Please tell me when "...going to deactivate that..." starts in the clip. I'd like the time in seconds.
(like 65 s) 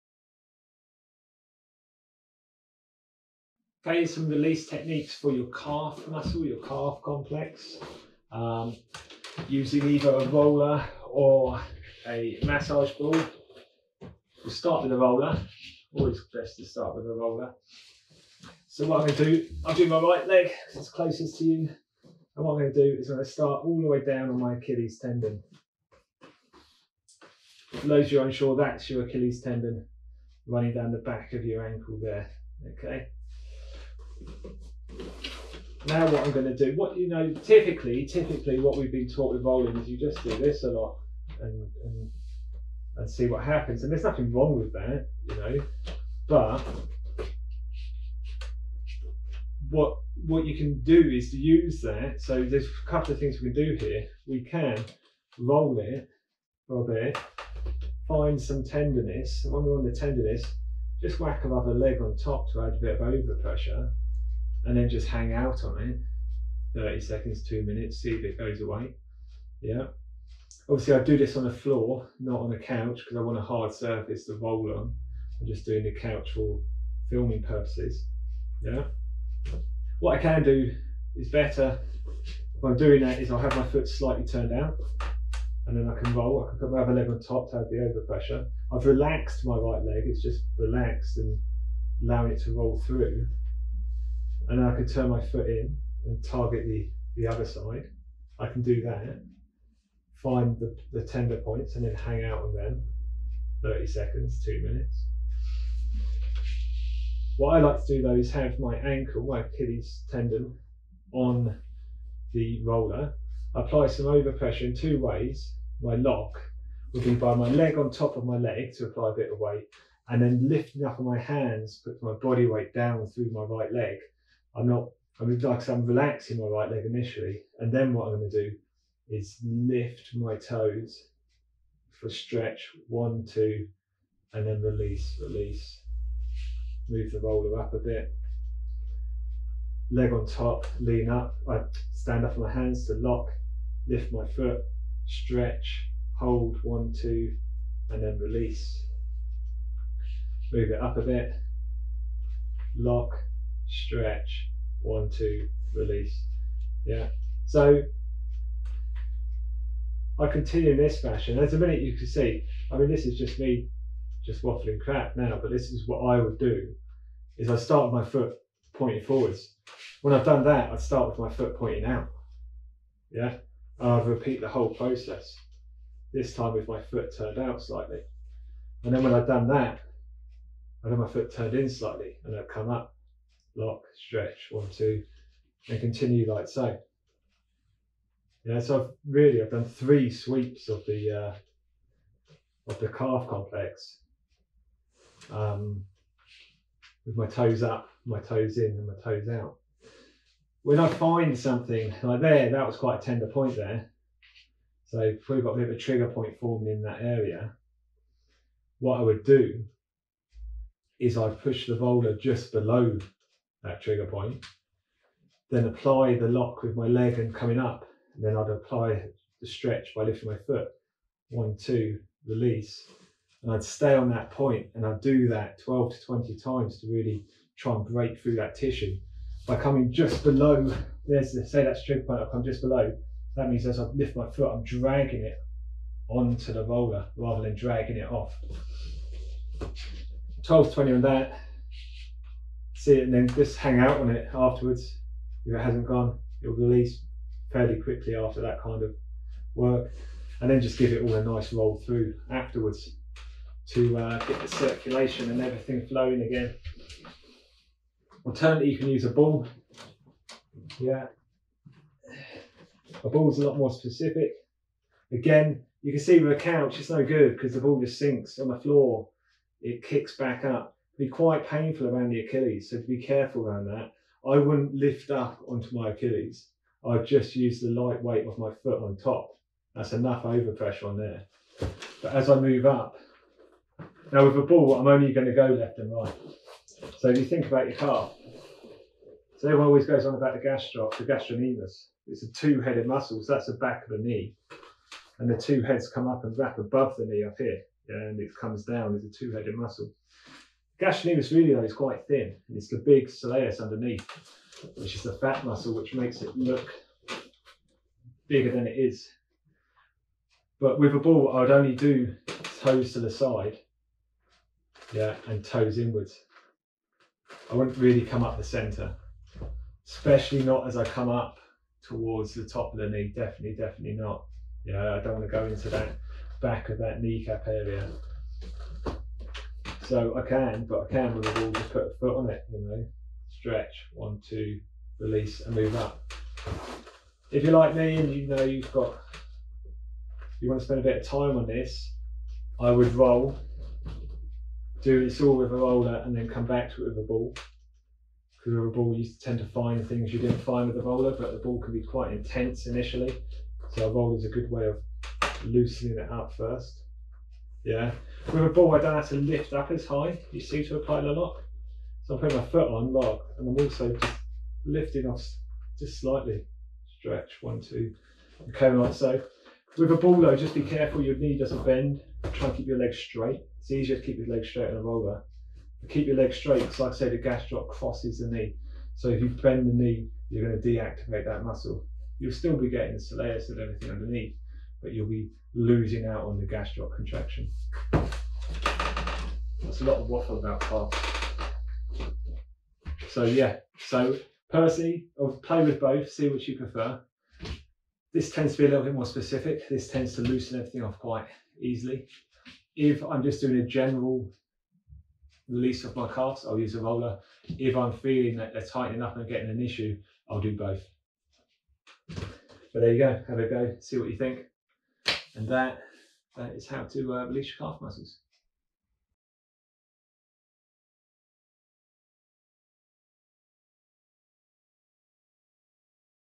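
380 s.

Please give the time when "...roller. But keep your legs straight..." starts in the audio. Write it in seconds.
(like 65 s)
374 s.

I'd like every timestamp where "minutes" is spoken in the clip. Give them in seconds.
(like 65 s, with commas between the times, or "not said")
67 s, 104 s, 161 s.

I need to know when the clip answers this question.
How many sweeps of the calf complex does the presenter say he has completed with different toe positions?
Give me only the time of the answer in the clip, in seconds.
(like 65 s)
189 s.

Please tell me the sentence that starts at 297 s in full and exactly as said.
And it comes down as a two-headed muscle.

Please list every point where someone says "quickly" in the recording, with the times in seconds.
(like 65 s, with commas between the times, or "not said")
247 s.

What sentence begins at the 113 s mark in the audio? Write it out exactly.
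apply some overpressure in two ways.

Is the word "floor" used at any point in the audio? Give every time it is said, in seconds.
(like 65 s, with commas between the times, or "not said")
71 s, 268 s.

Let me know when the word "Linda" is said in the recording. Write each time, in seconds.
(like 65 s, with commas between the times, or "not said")
not said.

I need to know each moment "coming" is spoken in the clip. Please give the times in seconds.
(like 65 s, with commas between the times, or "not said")
217 s, 229 s.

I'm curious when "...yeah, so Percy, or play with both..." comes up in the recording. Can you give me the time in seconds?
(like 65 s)
393 s.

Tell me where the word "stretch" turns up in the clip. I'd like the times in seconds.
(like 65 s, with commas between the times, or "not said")
132 s, 145 s, 153 s, 184 s, 219 s, 333 s, 366 s.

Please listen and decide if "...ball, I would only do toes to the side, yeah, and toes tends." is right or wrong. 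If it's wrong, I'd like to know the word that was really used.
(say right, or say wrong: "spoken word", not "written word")
wrong: "inwards", not "tends".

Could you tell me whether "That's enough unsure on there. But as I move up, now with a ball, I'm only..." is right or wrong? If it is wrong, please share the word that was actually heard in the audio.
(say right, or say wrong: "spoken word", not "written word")
wrong: "overpressure", not "unsure".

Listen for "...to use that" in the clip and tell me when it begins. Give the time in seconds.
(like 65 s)
51 s.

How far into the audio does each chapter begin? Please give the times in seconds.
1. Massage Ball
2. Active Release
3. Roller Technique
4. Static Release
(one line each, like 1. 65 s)
1. 257 s
2. 106 s
3. 22 s
4. 54 s.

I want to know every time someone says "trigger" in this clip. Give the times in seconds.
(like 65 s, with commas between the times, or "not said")
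205 s, 213 s, 231 s.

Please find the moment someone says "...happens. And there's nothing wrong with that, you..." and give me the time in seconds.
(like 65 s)
43 s.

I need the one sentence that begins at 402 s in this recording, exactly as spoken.
If I'm just doing a general release of my calves, I'll use a roller.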